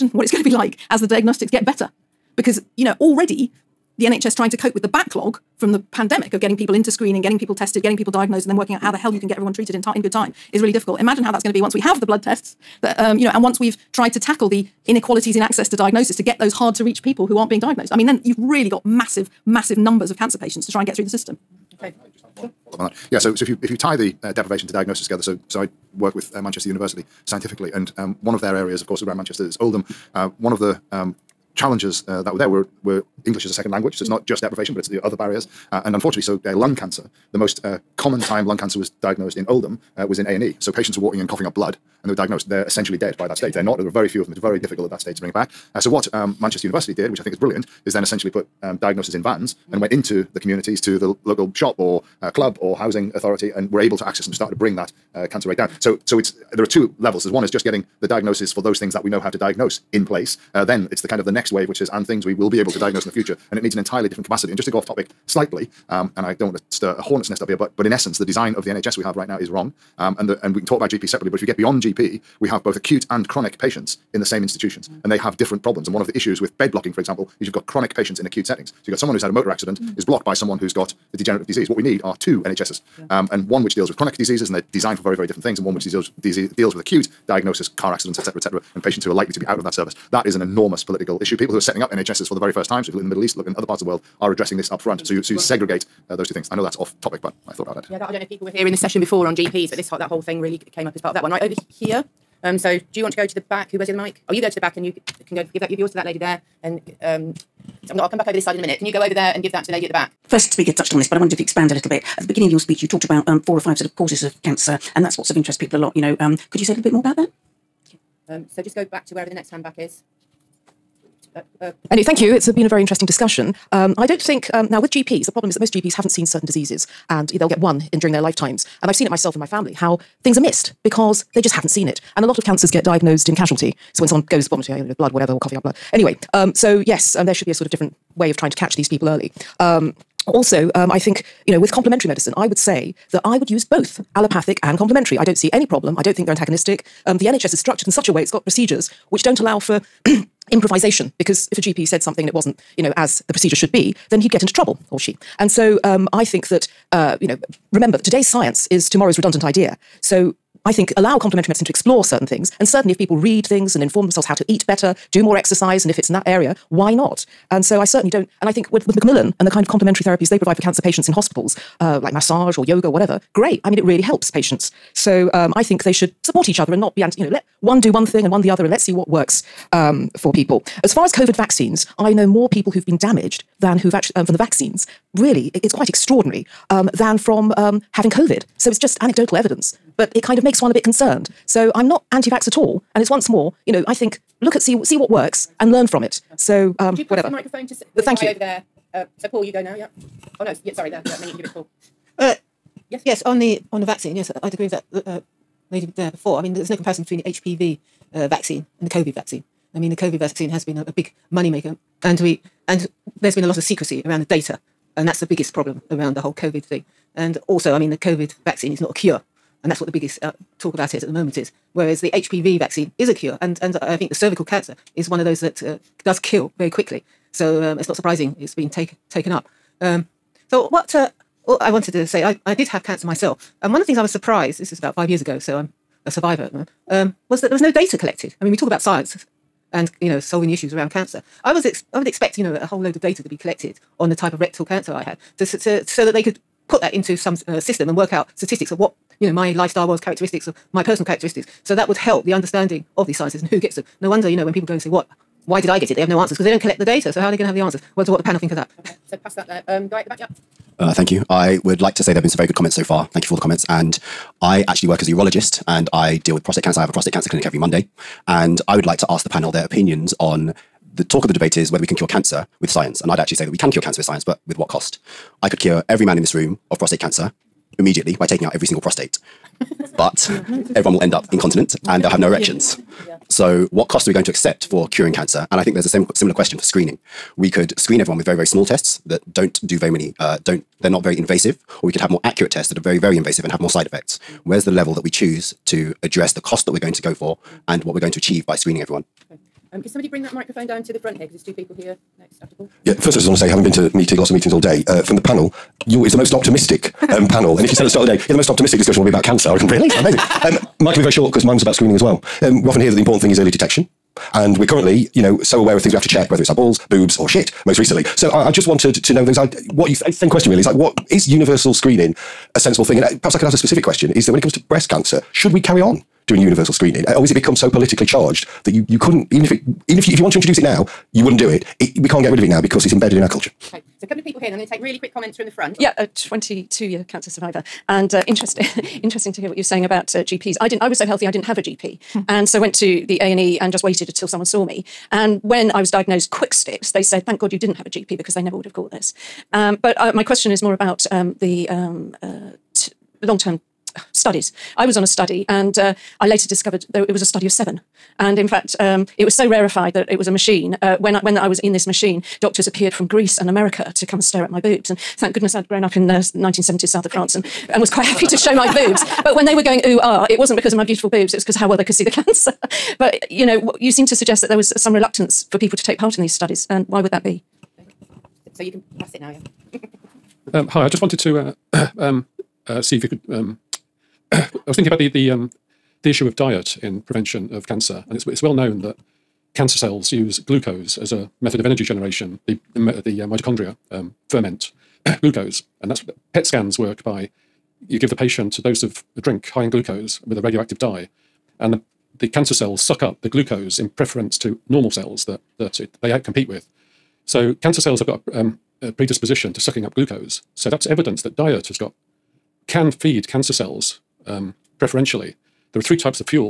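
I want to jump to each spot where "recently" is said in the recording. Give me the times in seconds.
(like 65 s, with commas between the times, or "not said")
317 s.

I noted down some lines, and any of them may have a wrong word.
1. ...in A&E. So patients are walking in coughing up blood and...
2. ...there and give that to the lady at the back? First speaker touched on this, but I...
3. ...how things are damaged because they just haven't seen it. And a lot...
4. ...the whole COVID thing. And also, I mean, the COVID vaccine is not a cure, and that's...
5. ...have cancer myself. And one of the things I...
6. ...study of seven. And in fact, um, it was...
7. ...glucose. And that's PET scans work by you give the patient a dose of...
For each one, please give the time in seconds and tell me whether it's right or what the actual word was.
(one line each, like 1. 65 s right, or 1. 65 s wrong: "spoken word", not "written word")
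1. 40 s right
2. 109 s right
3. 129 s wrong: "missed", not "damaged"
4. 216 s right
5. 232 s right
6. 357 s right
7. 395 s right.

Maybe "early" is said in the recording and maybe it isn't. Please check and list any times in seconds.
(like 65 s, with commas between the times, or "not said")
139 s, 313 s.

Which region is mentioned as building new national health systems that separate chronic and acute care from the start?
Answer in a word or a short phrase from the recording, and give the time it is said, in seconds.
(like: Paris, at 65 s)
Middle East, at 93 s.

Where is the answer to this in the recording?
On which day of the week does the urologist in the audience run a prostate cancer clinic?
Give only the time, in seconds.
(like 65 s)
267 s.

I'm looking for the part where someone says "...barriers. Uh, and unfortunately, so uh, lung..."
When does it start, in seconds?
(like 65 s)
35 s.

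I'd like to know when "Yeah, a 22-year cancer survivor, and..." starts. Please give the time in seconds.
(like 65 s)
335 s.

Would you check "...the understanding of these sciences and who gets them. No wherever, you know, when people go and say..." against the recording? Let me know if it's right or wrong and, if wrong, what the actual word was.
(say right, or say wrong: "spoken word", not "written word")
wrong: "wonder", not "wherever".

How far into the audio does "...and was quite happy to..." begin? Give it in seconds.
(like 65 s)
367 s.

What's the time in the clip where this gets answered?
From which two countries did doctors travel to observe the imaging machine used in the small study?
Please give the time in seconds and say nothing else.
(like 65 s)
363 s.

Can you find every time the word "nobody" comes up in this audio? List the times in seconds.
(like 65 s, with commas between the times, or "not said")
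not said.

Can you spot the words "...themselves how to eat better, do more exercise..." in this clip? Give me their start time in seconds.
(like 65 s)
164 s.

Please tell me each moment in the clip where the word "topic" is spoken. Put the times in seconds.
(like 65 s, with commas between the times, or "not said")
64 s, 97 s.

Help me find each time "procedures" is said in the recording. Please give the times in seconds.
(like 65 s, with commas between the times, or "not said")
148 s, 153 s.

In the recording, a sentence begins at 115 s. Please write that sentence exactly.
You know, um, could you say a little bit more about that?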